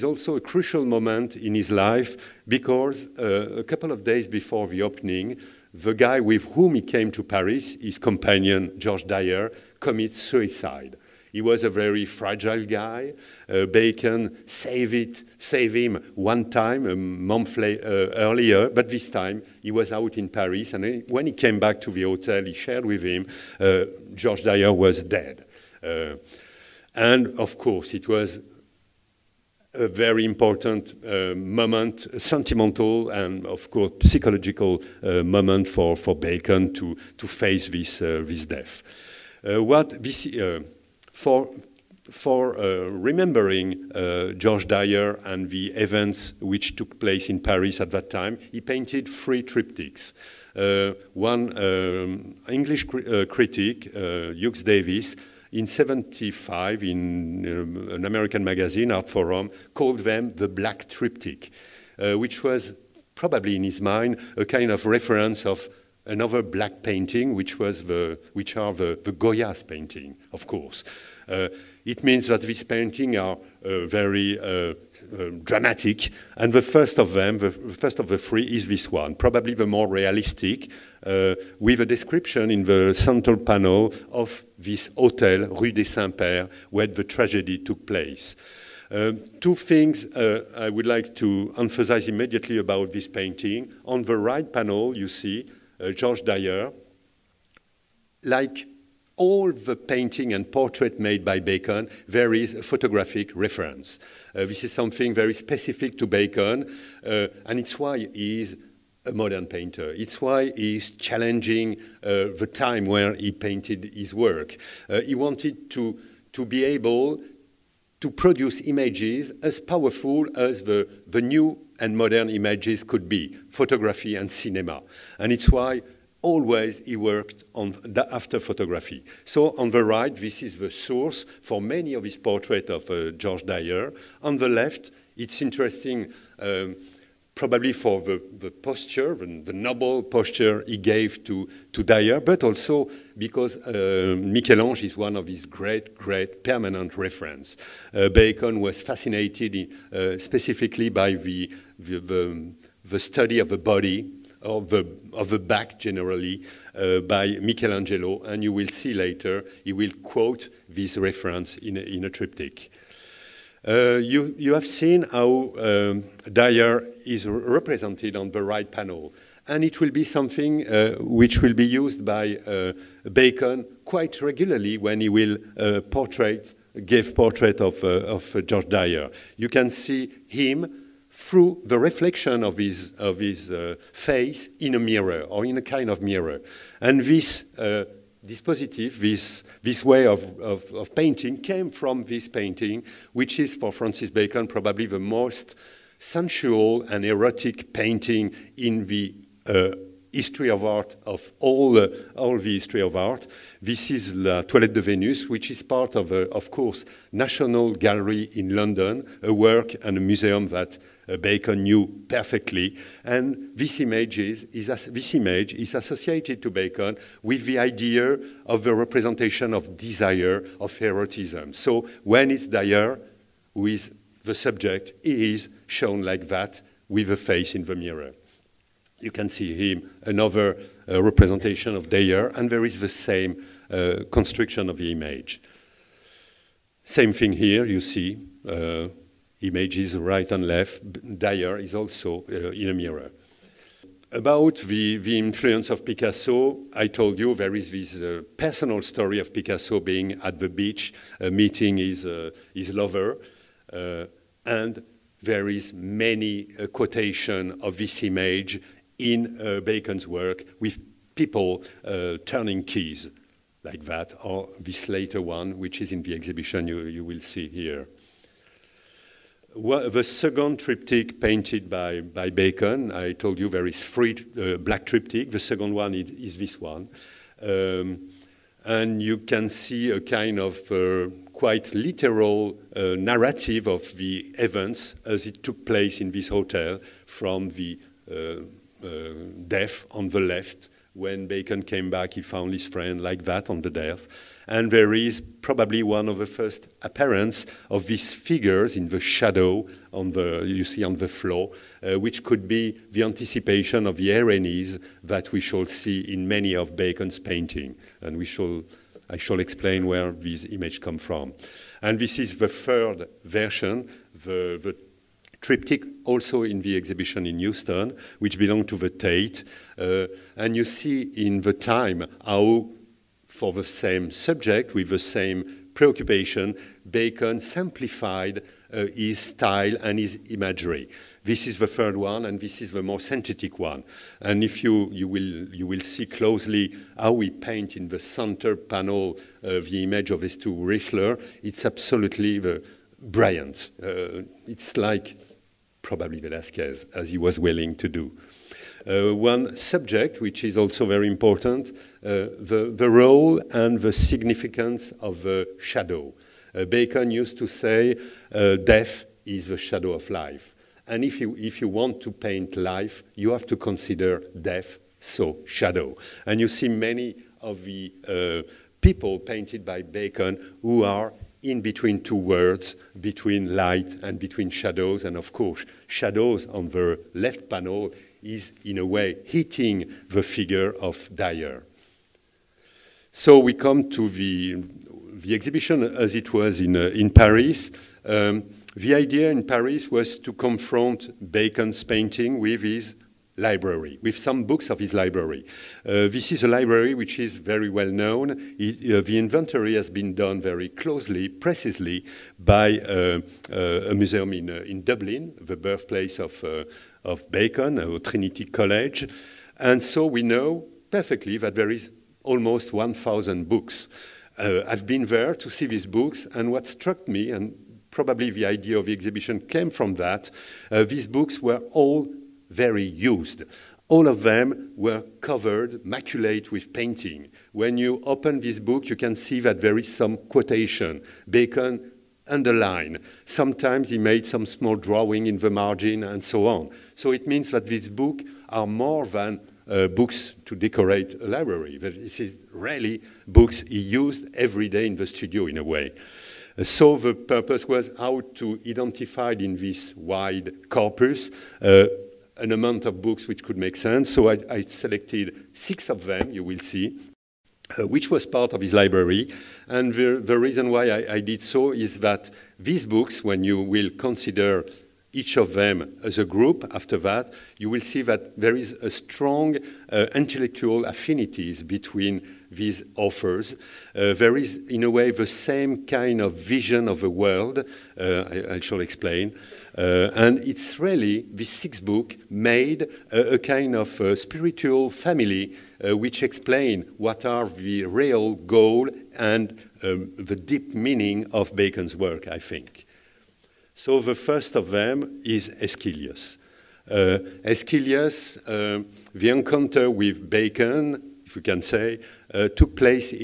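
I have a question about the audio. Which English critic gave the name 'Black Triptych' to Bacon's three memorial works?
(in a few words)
Hugh Davies.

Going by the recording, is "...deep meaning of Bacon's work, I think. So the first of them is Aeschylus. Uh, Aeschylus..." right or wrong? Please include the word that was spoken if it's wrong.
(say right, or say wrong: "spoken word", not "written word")
right.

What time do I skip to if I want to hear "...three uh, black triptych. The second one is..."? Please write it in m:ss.
4:33.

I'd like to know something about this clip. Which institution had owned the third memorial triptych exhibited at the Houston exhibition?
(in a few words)
the Tate.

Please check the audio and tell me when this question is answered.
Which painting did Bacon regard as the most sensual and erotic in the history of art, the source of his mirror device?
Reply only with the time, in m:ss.
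3:24.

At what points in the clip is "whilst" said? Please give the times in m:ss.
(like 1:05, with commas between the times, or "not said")
not said.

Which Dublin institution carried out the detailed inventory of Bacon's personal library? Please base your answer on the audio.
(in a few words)
Trinity College.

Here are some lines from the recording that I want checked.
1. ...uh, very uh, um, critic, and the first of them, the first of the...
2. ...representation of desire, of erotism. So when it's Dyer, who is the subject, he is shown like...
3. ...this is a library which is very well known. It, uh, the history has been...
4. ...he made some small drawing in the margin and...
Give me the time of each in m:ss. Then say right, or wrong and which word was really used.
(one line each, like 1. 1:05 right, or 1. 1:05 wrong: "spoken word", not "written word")
1. 1:13 wrong: "dramatic", not "critic"
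2. 3:38 right
3. 6:36 wrong: "inventory", not "history"
4. 7:13 right.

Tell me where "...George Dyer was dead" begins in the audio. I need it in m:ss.
0:24.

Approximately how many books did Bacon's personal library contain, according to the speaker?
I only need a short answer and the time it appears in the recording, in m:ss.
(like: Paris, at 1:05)
1,000, at 6:52.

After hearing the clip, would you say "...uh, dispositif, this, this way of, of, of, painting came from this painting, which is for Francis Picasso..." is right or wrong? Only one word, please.
wrong.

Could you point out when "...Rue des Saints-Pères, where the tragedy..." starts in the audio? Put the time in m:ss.
1:25.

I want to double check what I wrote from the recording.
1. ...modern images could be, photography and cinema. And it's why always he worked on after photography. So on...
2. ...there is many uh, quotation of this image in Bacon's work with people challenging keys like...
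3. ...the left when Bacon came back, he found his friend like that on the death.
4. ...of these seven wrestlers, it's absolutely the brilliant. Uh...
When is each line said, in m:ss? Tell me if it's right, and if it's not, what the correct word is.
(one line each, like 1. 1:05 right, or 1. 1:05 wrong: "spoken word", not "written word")
1. 2:01 right
2. 4:15 wrong: "turning", not "challenging"
3. 4:50 right
4. 5:40 wrong: "two", not "seven".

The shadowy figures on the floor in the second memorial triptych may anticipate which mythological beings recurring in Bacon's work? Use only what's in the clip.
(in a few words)
Erinyes.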